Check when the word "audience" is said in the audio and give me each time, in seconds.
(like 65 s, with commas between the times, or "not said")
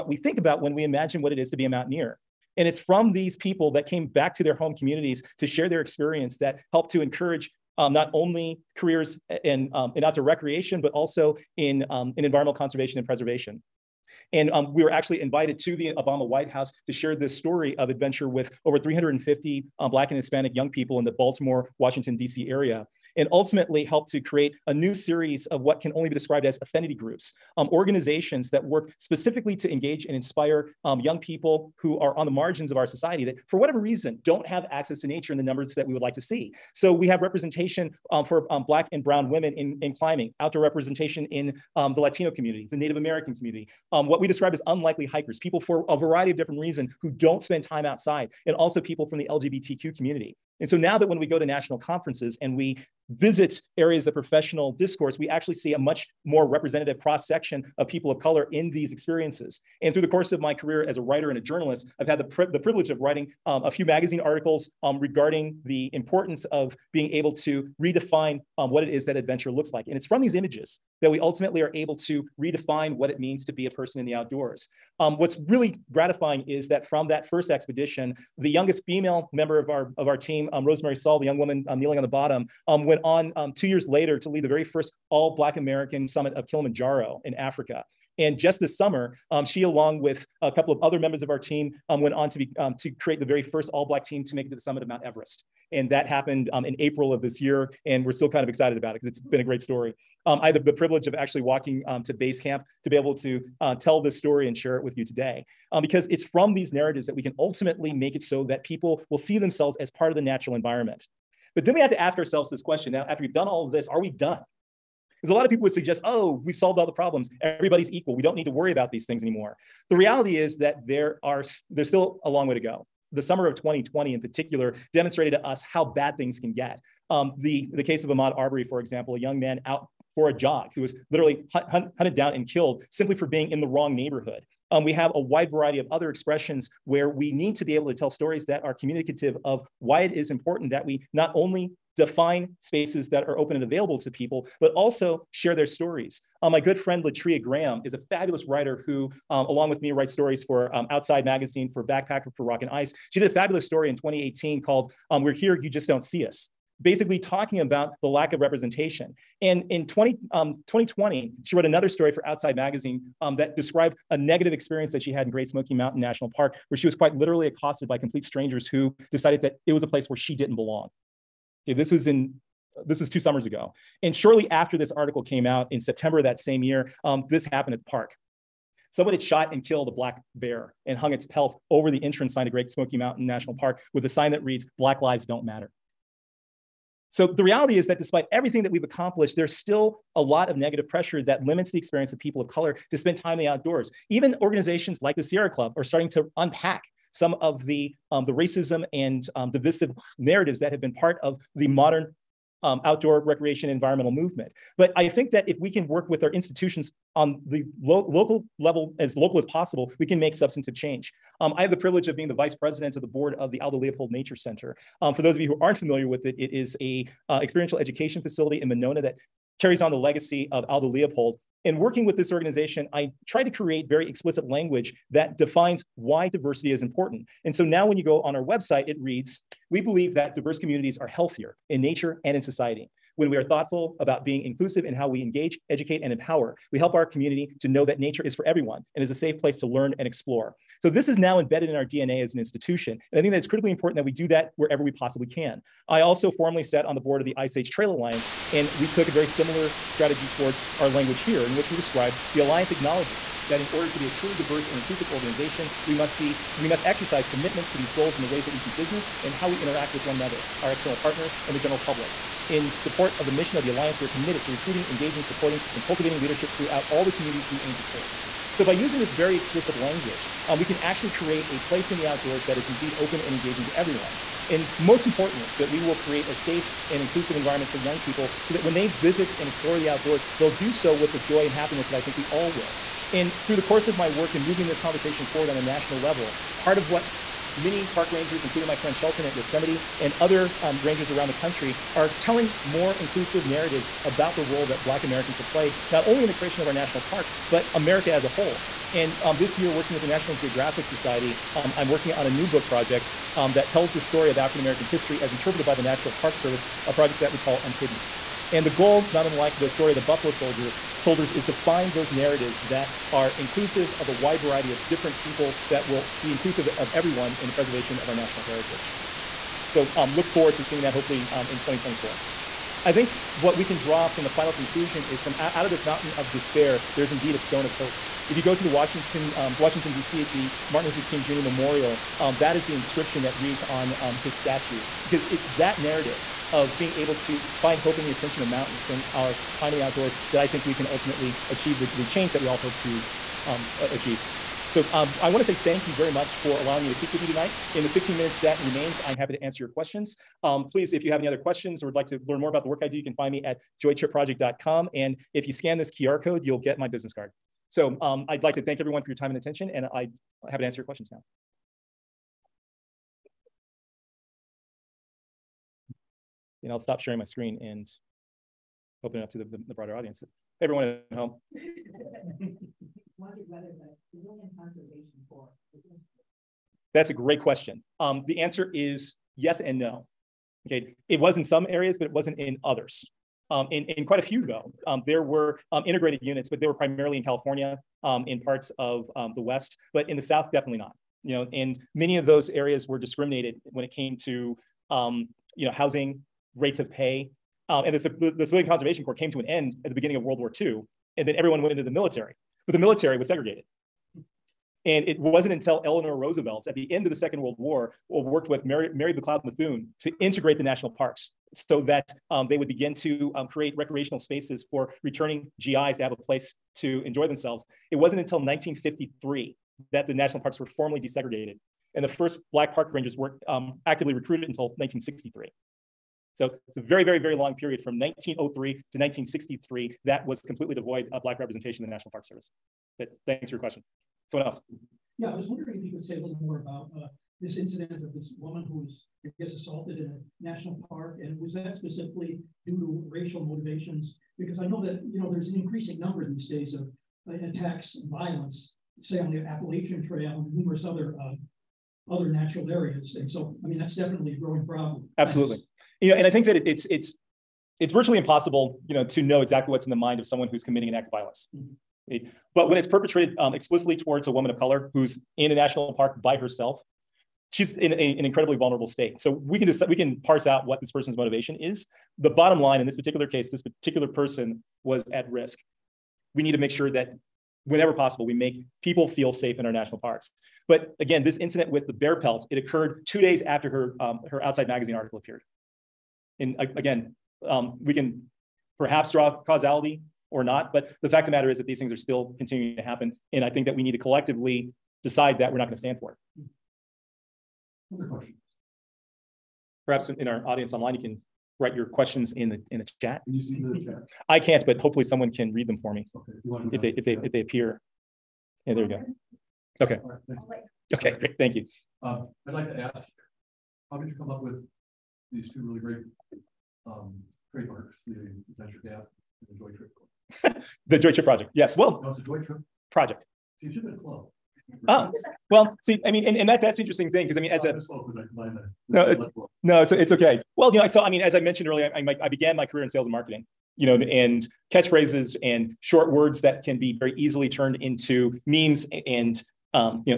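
369 s, 500 s.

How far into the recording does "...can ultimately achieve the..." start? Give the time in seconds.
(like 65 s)
340 s.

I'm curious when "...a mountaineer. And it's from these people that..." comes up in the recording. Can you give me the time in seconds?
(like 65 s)
1 s.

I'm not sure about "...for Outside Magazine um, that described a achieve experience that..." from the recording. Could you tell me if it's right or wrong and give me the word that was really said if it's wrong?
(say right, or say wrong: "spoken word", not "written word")
wrong: "negative", not "achieve".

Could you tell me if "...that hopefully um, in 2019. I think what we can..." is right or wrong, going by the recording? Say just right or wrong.
wrong.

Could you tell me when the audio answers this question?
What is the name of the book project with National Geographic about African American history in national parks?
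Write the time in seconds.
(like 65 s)
307 s.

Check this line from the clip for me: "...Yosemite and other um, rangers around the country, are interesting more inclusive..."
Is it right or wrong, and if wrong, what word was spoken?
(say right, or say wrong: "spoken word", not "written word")
wrong: "telling", not "interesting".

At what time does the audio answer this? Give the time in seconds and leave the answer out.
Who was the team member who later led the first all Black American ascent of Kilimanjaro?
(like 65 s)
80 s.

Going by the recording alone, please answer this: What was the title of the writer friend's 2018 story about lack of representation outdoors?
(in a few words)
We're Here, You Just Don't See Us.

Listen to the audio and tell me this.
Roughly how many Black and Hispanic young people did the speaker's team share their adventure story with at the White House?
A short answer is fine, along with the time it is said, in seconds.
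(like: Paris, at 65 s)
350, at 18 s.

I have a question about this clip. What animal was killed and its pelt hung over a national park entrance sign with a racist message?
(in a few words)
Black bear.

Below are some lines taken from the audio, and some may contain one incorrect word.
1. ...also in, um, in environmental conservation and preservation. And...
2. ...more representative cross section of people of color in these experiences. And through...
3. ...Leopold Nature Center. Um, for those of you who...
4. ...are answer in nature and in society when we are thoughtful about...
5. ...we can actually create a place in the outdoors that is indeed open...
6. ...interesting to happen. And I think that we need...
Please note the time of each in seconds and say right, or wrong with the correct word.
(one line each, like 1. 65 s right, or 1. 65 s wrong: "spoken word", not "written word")
1. 10 s right
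2. 56 s right
3. 213 s right
4. 230 s wrong: "healthier", not "answer"
5. 270 s right
6. 492 s wrong: "continuing", not "interesting".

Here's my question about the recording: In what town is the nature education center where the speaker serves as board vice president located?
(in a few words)
Monona.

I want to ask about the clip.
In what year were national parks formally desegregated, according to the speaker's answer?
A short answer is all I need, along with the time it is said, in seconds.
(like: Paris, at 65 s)
1953, at 418 s.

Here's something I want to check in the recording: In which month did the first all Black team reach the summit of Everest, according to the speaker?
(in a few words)
April.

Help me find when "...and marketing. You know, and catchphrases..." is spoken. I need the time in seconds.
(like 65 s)
533 s.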